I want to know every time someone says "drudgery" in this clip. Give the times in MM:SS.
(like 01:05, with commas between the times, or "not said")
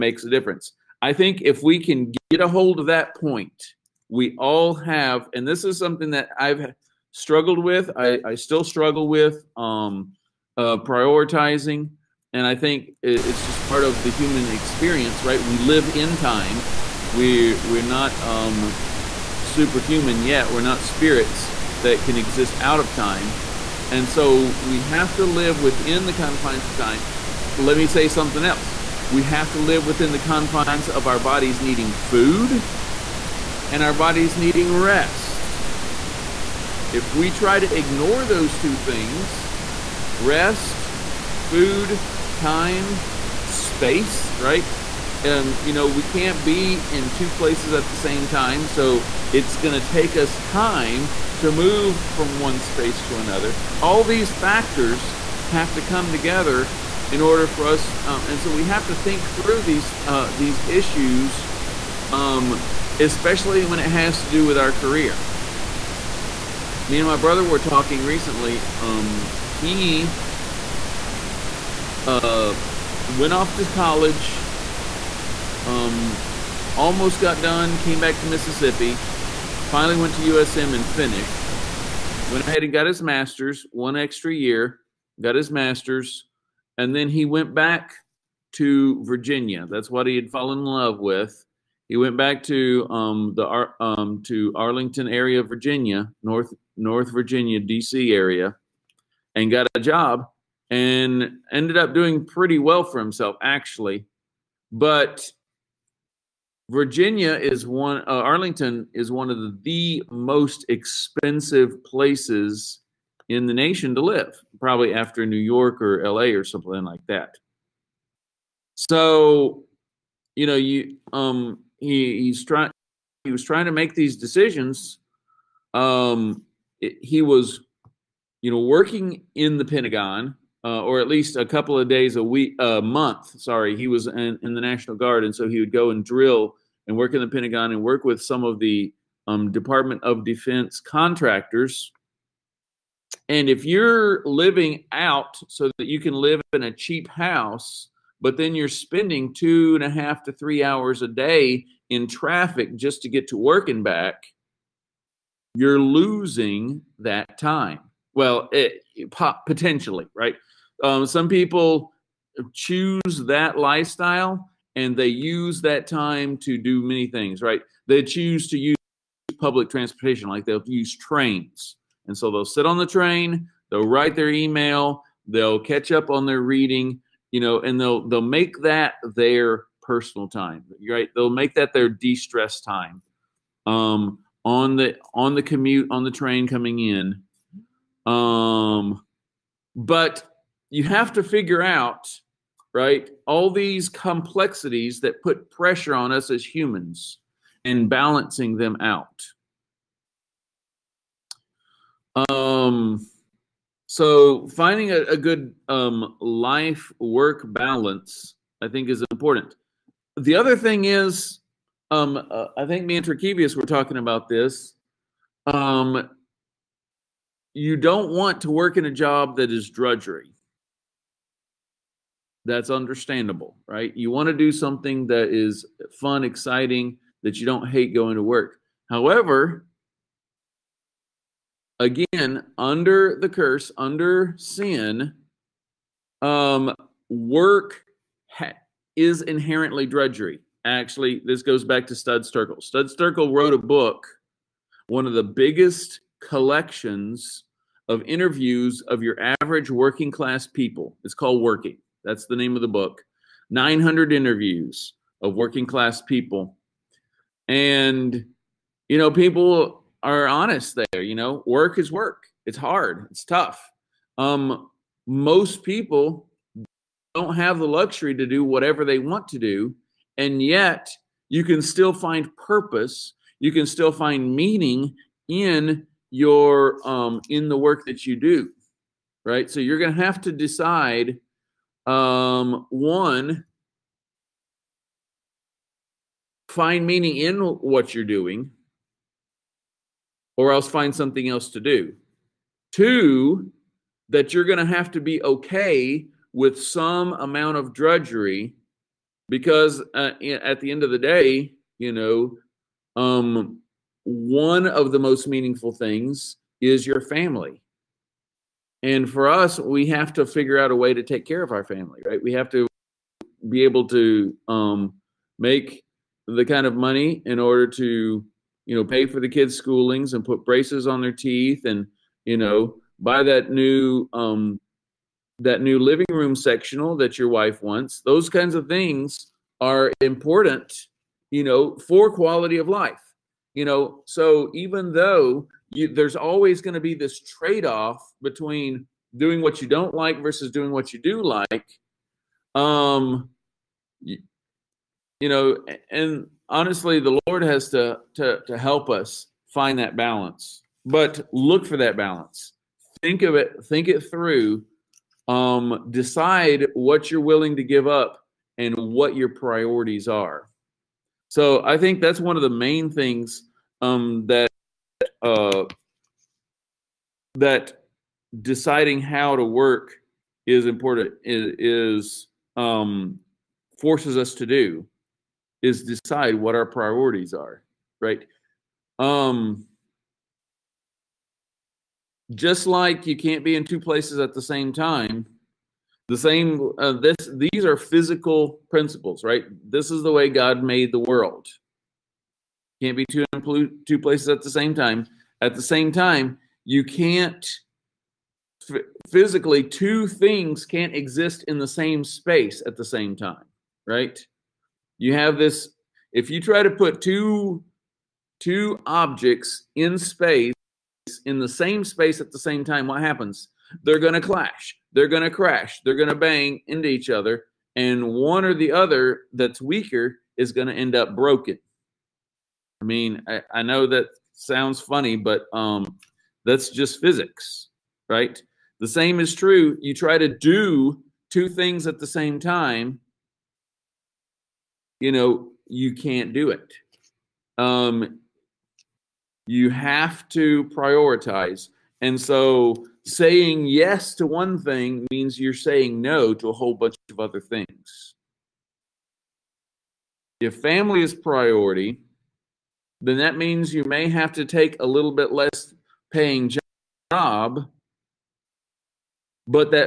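03:39, 03:59, 04:57.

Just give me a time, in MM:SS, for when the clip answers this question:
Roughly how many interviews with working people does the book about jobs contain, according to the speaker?
04:13.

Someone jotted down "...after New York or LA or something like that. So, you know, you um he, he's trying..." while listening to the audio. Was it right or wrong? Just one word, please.
right.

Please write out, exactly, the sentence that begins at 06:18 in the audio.
Um, just like you can't be in two places at the same time, the same uh, this these are physical principles, right?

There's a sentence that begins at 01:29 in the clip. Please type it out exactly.
That's what he had fallen in love with.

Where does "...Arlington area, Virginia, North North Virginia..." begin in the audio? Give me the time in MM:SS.
01:34.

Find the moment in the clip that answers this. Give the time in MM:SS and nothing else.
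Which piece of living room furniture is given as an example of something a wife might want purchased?
05:26.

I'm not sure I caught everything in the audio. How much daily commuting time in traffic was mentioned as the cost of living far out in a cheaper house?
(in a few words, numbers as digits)
2.5 to 3 hours.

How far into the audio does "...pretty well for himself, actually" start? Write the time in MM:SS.
01:42.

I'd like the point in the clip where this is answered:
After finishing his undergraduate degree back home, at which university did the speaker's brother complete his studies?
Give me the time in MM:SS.
01:20.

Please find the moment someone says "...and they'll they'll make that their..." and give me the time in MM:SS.
02:57.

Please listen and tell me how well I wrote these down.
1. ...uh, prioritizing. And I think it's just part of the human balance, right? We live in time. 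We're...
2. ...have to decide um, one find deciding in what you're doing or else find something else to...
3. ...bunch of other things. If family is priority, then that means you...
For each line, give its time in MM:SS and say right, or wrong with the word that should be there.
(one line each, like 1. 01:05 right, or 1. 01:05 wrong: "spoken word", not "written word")
1. 00:10 wrong: "experience", not "balance"
2. 04:40 wrong: "meaning", not "deciding"
3. 07:26 right.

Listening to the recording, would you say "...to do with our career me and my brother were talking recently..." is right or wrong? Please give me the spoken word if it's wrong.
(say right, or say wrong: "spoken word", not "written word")
right.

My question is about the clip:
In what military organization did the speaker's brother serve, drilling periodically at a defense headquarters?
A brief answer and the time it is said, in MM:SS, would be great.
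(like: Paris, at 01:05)
National Guard, at 02:14.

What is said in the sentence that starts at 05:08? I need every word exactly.
And for us, we have to figure out a way to take care of our family, right?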